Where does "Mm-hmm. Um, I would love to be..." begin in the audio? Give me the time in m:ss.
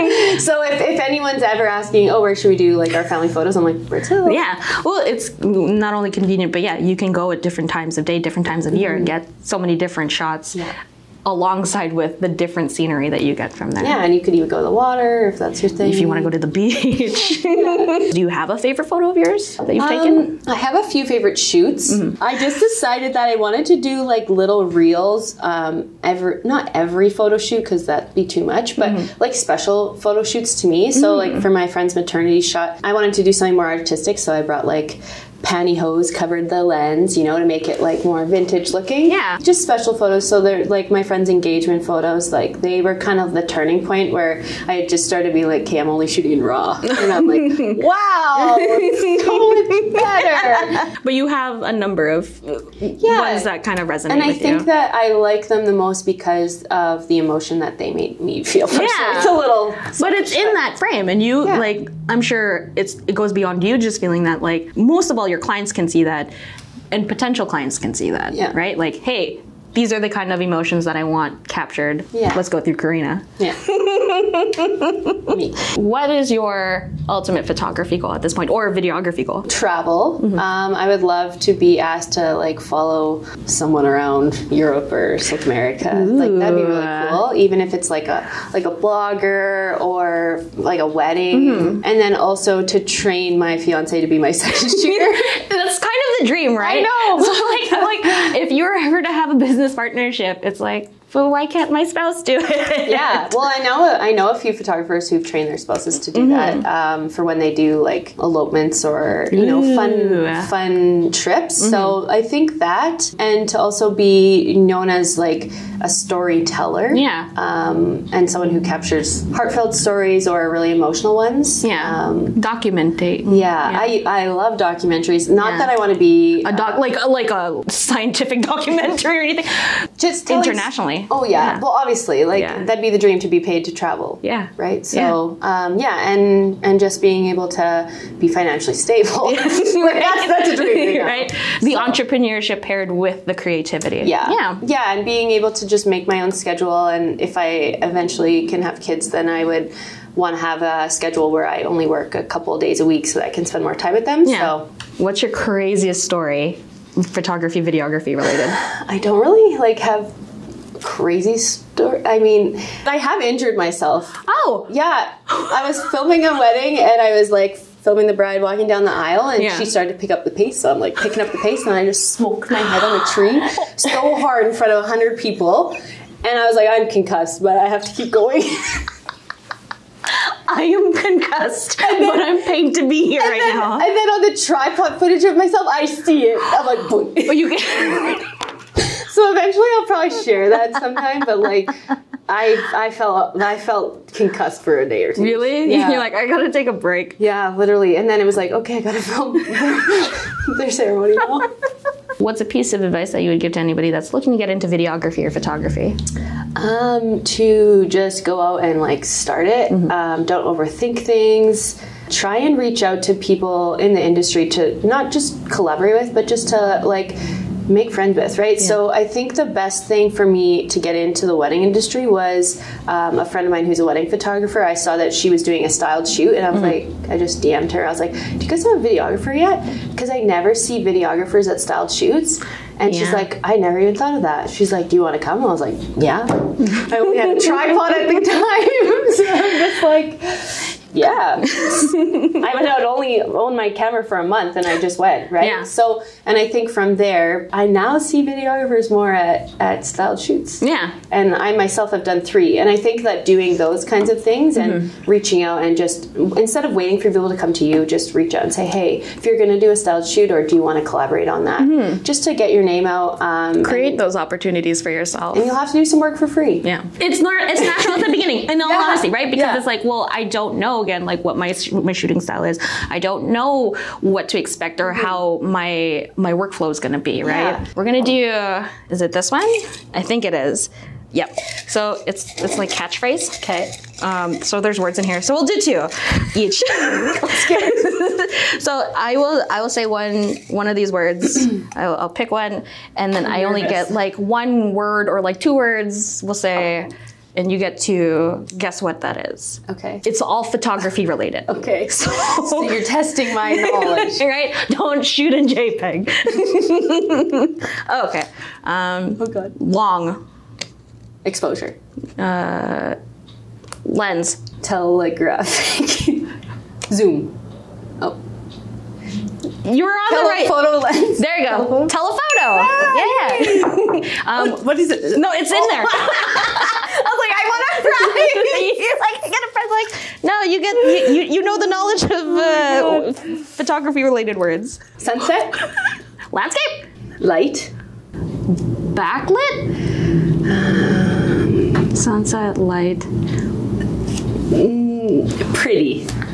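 1:20.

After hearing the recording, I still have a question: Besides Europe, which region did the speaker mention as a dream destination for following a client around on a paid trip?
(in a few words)
South America.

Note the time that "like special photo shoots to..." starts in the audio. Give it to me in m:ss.
0:29.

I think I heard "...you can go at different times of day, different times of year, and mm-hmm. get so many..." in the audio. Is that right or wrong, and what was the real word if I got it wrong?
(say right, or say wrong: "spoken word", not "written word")
right.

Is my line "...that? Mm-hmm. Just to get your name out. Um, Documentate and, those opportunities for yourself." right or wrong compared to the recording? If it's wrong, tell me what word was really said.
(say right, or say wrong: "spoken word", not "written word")
wrong: "Create", not "Documentate".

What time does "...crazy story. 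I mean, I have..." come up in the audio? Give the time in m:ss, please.
2:40.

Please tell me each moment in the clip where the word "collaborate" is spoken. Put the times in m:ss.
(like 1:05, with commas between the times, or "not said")
3:35, 4:20.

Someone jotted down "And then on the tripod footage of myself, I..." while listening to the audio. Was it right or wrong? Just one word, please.
right.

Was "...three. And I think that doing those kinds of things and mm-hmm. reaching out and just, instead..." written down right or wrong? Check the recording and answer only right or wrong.
right.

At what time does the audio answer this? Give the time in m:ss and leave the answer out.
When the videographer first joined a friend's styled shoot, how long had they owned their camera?
4:04.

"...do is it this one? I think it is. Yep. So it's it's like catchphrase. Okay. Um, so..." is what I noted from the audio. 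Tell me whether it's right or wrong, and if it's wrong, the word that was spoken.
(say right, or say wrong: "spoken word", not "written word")
right.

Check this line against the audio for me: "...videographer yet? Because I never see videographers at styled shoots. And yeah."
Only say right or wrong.
right.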